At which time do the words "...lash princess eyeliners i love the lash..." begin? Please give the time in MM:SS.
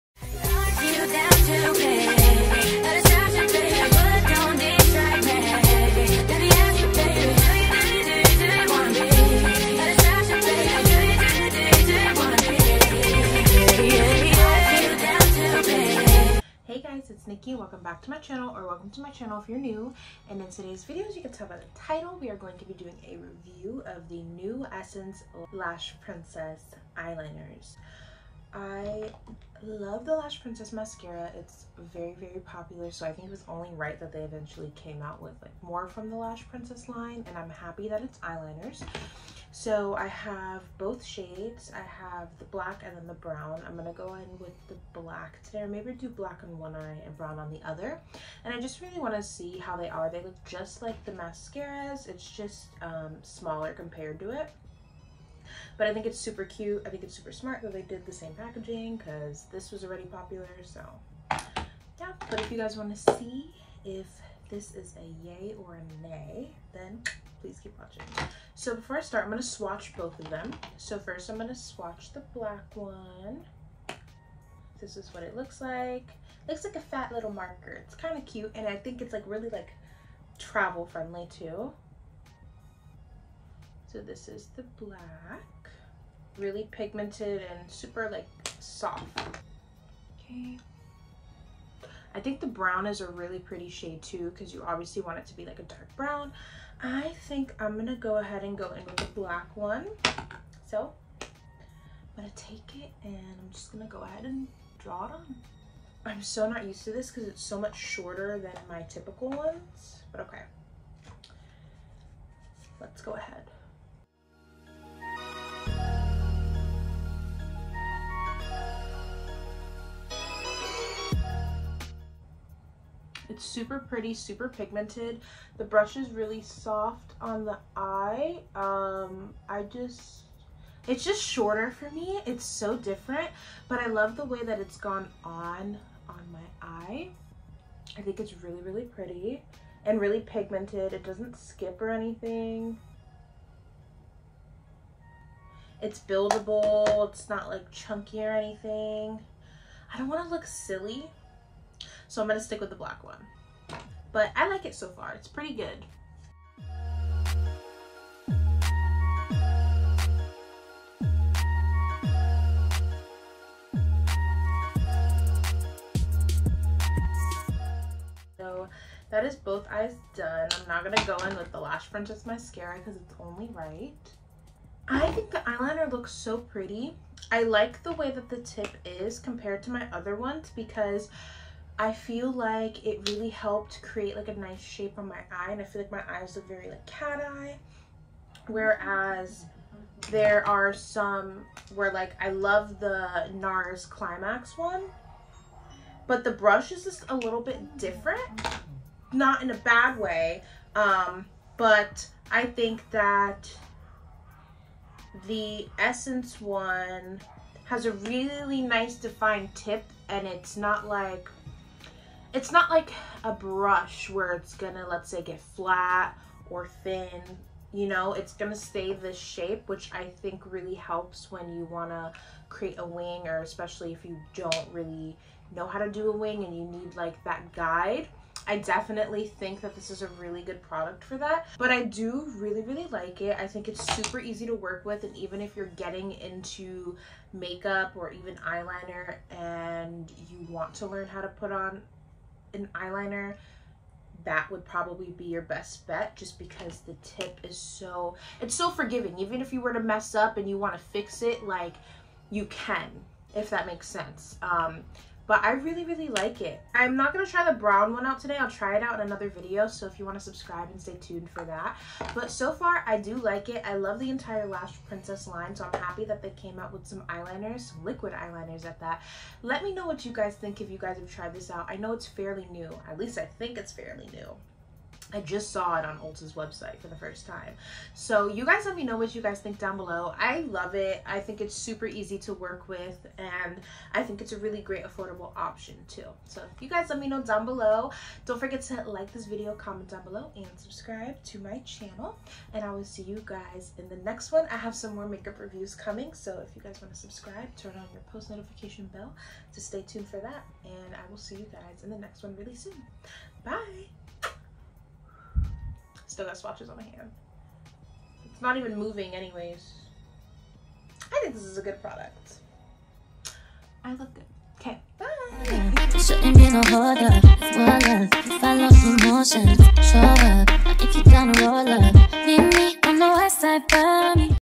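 00:25.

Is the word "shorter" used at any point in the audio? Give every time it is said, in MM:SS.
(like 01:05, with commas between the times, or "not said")
01:47, 02:11.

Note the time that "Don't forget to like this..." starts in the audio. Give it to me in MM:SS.
04:48.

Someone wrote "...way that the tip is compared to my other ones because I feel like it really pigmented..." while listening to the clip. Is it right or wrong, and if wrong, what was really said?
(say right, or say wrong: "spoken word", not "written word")
wrong: "helped", not "pigmented".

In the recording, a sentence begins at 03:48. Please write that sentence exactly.
I definitely think that this is a really good product for that, but I do really, really like it.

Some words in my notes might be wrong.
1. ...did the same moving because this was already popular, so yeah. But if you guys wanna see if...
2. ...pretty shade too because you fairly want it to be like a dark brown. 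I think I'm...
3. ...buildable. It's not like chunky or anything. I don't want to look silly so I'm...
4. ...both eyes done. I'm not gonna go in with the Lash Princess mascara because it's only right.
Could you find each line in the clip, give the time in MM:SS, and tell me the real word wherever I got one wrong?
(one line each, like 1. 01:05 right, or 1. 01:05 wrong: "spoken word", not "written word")
1. 00:57 wrong: "packaging", not "moving"
2. 01:33 wrong: "obviously", not "fairly"
3. 02:26 right
4. 02:49 right.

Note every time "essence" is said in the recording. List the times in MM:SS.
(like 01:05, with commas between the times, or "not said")
00:24, 03:25.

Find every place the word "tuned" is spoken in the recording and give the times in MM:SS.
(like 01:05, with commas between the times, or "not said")
04:20, 04:59.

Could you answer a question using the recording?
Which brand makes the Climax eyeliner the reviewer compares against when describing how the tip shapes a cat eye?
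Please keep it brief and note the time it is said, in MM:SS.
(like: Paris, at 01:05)
NARS, at 03:13.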